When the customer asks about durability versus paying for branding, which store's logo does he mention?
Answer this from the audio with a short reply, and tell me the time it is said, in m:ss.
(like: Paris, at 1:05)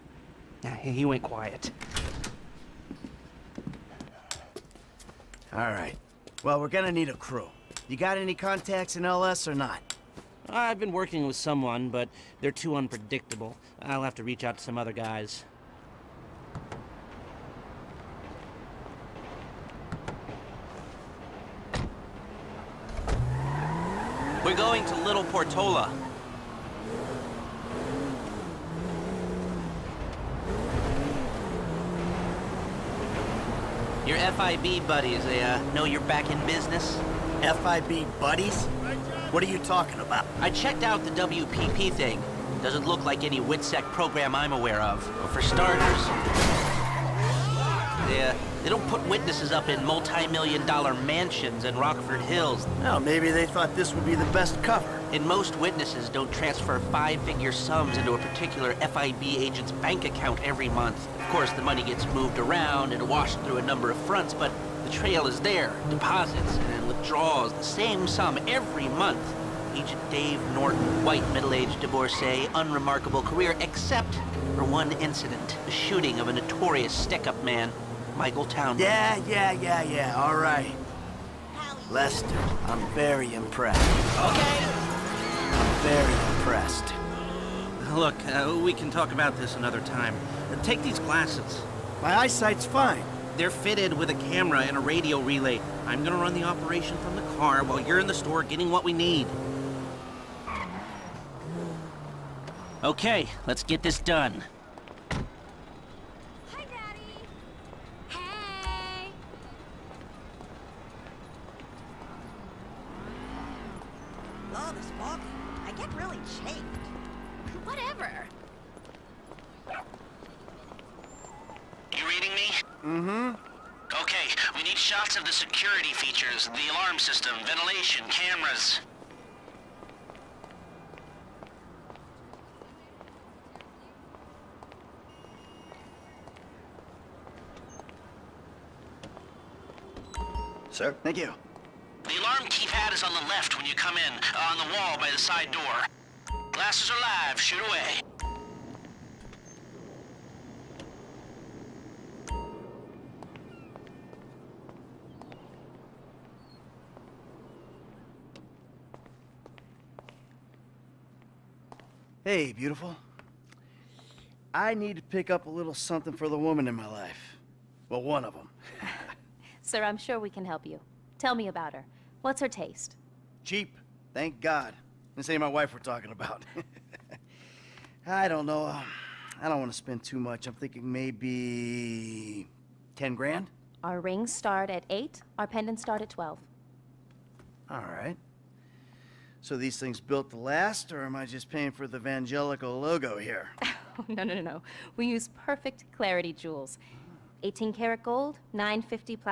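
Vangelico, at 3:11.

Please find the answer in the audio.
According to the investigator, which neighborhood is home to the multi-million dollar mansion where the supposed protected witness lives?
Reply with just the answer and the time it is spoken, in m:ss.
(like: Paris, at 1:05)
Rockford Hills, at 0:51.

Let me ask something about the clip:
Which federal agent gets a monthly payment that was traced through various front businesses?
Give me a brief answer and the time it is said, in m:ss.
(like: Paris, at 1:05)
Dave Norton, at 1:10.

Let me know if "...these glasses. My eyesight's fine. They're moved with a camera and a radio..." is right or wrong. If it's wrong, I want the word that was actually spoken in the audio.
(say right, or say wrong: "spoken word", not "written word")
wrong: "fitted", not "moved".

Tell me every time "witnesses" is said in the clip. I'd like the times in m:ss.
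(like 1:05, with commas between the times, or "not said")
0:49, 0:55.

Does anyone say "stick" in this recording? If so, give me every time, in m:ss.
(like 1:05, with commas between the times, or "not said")
1:16.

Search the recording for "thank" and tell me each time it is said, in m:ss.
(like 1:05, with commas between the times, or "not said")
2:21, 2:54.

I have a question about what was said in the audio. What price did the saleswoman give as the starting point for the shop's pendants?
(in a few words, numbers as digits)
12.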